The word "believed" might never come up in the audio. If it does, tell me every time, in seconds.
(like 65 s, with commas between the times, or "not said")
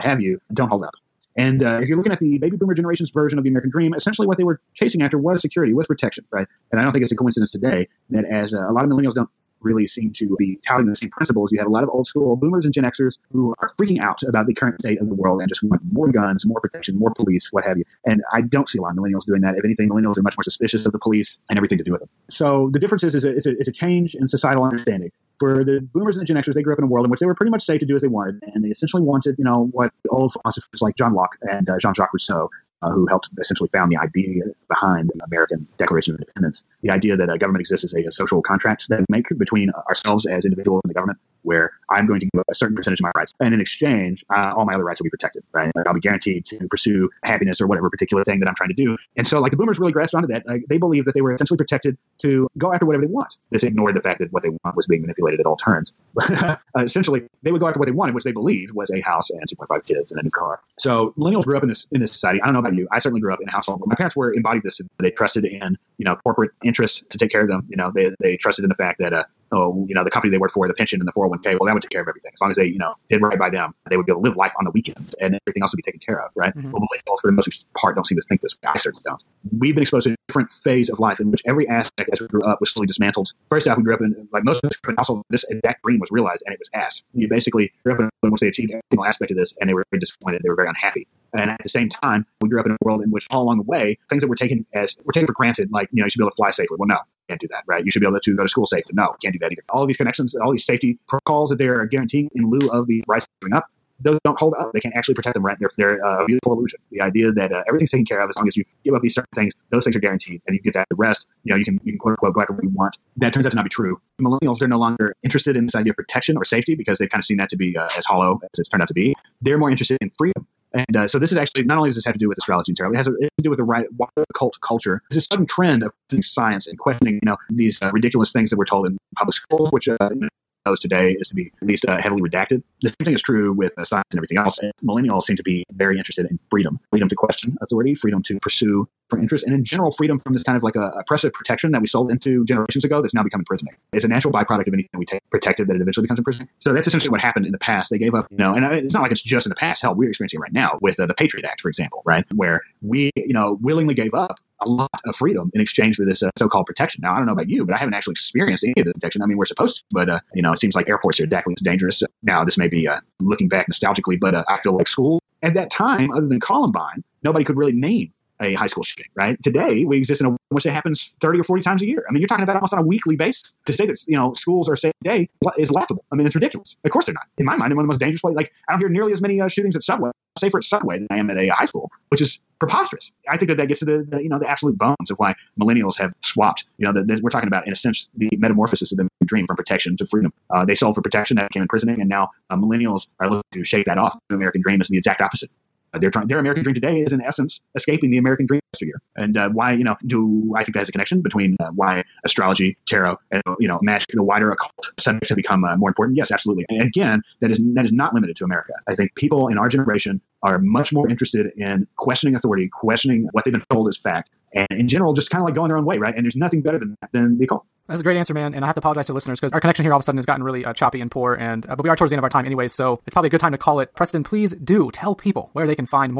50 s, 58 s.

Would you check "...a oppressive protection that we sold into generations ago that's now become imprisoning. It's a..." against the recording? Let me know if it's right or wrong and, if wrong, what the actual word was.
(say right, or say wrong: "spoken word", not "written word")
right.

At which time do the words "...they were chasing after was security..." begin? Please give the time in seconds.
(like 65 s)
4 s.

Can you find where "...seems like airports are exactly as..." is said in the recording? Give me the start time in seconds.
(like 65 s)
160 s.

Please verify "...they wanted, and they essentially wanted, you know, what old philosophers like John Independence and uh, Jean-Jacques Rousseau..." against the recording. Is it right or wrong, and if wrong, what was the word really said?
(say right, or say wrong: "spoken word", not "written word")
wrong: "Locke", not "Independence".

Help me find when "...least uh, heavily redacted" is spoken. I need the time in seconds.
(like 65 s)
131 s.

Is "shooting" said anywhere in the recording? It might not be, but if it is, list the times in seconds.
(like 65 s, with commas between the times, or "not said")
168 s, 179 s.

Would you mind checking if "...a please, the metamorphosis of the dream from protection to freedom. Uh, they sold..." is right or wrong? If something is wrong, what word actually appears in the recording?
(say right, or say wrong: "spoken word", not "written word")
wrong: "sense", not "please".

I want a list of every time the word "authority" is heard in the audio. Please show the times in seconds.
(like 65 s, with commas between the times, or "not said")
137 s, 212 s.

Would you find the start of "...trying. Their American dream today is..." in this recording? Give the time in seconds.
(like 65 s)
196 s.